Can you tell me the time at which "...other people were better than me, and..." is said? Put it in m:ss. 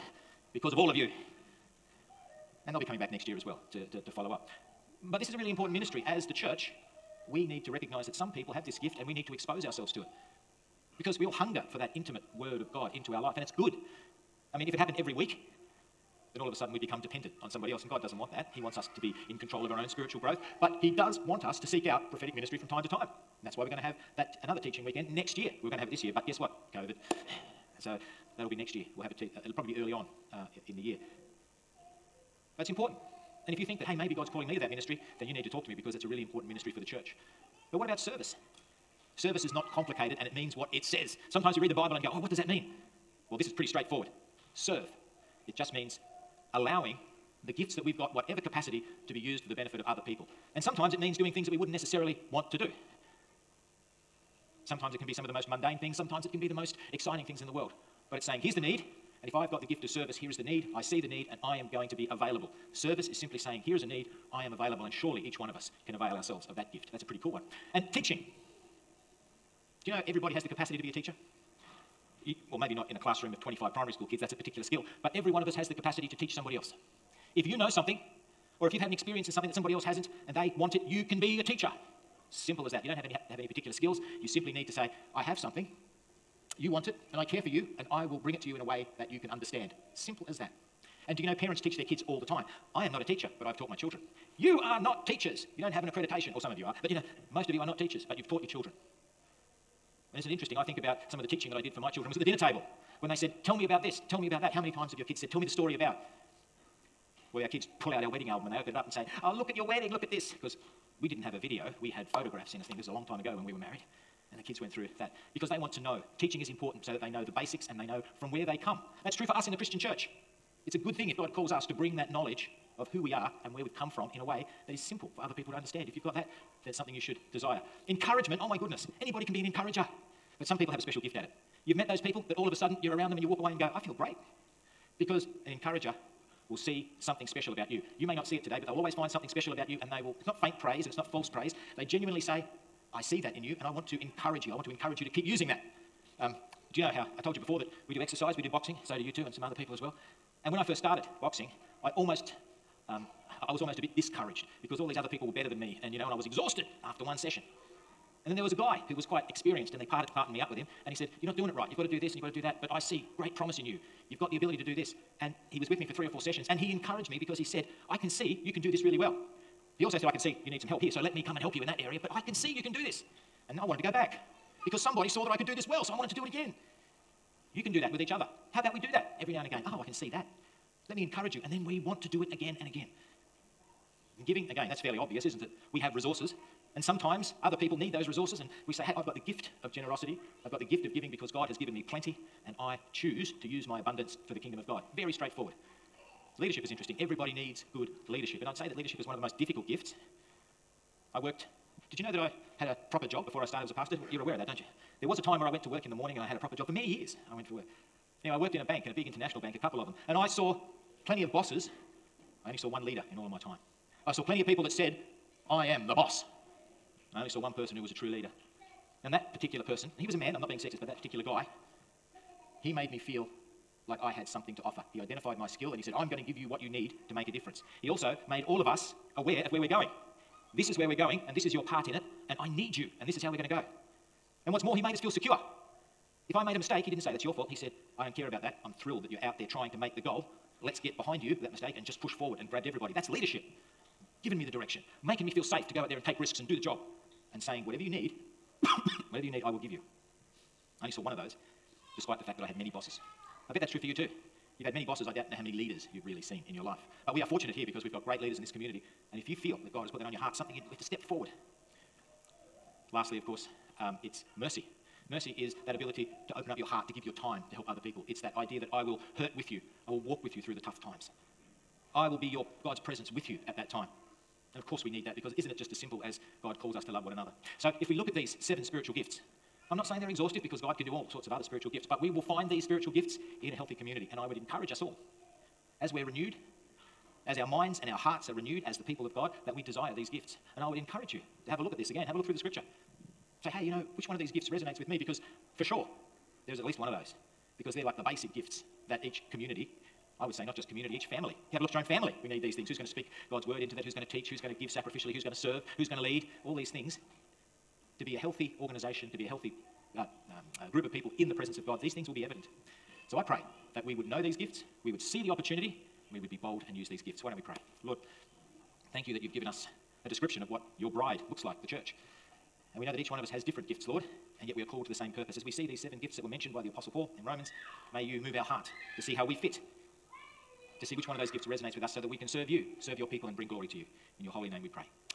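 2:34.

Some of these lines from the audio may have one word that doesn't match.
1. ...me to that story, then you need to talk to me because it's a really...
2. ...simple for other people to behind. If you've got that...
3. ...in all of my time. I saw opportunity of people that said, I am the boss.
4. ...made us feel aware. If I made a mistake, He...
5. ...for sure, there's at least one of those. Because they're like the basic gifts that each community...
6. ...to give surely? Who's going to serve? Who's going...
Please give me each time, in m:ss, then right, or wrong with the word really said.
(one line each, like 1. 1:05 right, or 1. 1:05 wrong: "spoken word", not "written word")
1. 0:34 wrong: "ministry", not "story"
2. 2:04 wrong: "understand", not "behind"
3. 3:33 wrong: "plenty", not "opportunity"
4. 3:54 wrong: "secure", not "aware"
5. 4:55 right
6. 5:04 wrong: "sacrificially", not "surely".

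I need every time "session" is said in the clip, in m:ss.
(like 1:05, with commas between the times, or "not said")
2:37, 2:46.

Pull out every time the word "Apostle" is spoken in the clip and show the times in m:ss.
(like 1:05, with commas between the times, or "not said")
5:26.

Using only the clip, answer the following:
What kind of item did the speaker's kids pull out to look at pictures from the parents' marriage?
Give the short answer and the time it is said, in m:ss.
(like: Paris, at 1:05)
Wedding album, at 1:48.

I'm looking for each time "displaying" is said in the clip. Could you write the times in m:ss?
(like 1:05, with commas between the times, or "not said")
not said.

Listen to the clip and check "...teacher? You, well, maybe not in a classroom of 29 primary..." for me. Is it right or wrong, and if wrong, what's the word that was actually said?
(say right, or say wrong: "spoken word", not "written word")
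wrong: "25", not "29".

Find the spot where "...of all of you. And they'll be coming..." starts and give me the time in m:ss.
0:00.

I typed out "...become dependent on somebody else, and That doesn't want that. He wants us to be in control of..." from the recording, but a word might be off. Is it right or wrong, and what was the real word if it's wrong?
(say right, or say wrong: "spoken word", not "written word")
wrong: "God", not "That".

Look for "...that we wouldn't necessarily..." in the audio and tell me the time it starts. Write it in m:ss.
0:51.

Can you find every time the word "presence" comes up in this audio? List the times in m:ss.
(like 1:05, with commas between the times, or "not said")
4:32, 5:11.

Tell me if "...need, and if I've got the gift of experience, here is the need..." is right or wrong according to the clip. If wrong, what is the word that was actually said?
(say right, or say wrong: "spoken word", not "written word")
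wrong: "service", not "experience".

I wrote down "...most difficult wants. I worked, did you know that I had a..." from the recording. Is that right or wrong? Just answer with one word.
wrong.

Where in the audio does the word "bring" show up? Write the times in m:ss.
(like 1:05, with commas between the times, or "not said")
1:28, 2:01, 5:33.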